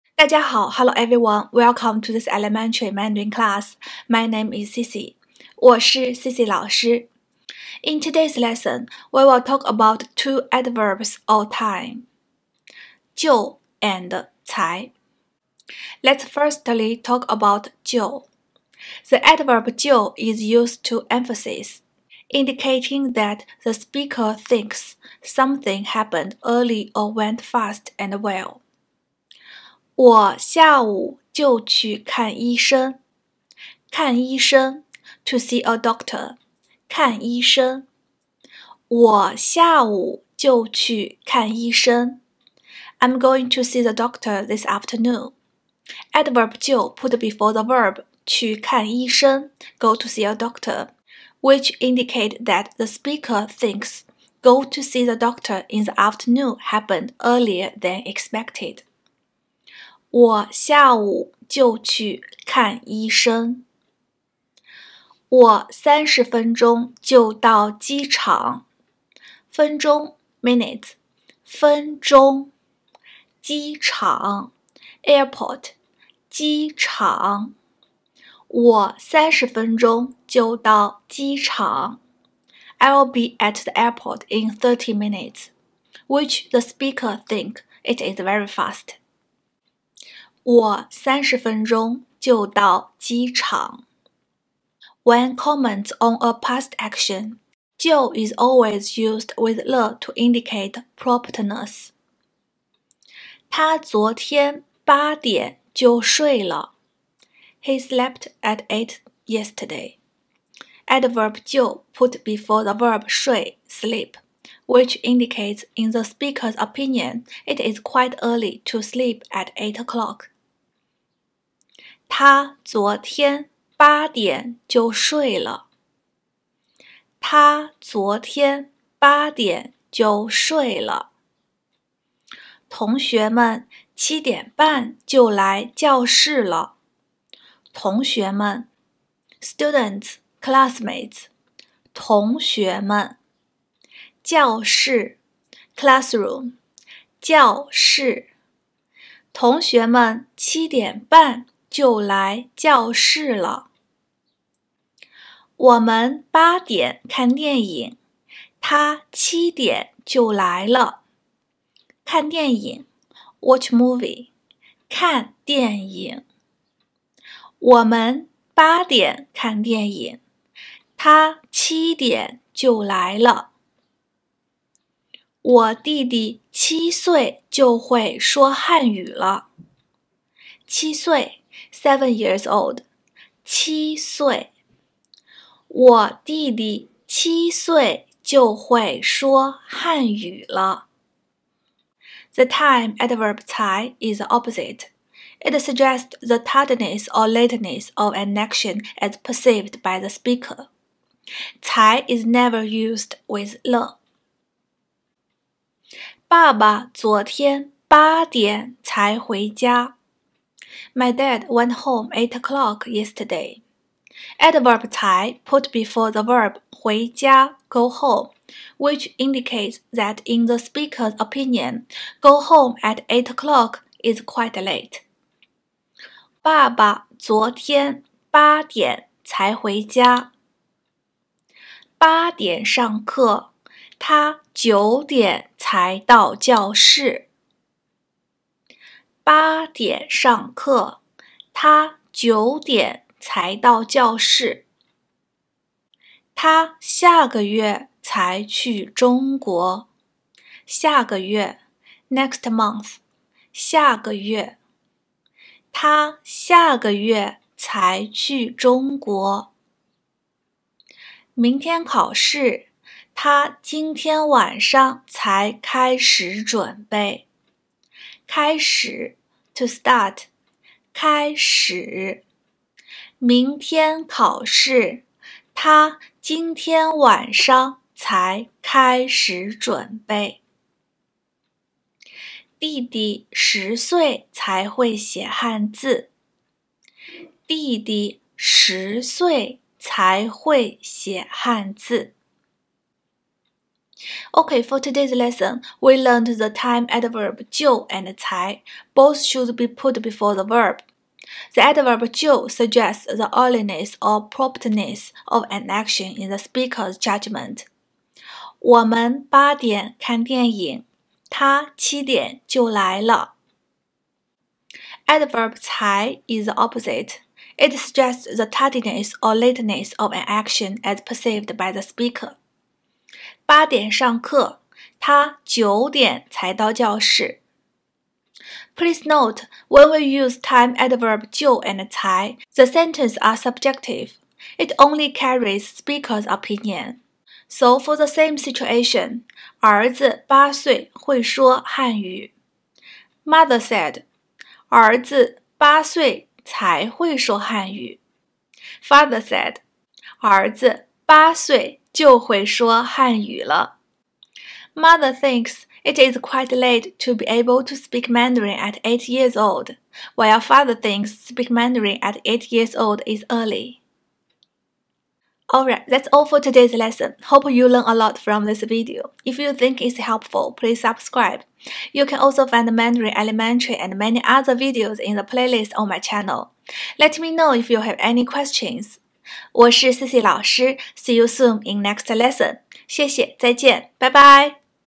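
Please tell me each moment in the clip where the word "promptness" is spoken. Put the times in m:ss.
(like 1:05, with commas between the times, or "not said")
1:40, 5:04.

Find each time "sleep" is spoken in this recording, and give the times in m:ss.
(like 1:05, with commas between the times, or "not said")
1:53, 1:58.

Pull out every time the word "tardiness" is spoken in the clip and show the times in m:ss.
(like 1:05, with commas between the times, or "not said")
3:16, 5:18.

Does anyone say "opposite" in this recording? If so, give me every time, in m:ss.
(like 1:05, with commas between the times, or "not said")
3:14, 5:16.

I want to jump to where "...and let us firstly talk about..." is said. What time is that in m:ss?
0:13.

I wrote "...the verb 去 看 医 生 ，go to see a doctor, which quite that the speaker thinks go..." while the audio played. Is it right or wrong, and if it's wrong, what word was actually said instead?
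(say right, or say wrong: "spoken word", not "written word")
wrong: "indicate", not "quite".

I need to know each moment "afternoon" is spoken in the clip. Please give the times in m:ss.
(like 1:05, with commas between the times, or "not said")
0:44, 0:55.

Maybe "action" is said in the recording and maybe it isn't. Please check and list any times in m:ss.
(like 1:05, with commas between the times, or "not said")
1:36, 3:18, 5:05, 5:20.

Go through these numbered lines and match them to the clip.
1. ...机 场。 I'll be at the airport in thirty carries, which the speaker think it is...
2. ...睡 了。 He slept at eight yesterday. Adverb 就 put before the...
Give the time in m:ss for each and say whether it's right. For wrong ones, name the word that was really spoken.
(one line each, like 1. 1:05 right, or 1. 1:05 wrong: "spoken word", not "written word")
1. 1:21 wrong: "minutes", not "carries"
2. 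1:46 right.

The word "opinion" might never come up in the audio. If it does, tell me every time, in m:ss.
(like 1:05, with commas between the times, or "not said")
1:56, 3:41, 5:36.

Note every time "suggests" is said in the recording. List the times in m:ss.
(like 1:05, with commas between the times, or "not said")
3:15, 5:02, 5:17.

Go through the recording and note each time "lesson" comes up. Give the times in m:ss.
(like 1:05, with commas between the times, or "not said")
0:08, 4:55, 6:06, 6:22.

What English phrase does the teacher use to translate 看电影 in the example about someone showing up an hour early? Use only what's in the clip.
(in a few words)
watch movie.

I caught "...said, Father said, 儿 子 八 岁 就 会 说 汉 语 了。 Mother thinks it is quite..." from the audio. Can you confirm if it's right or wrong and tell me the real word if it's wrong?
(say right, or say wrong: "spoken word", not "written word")
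right.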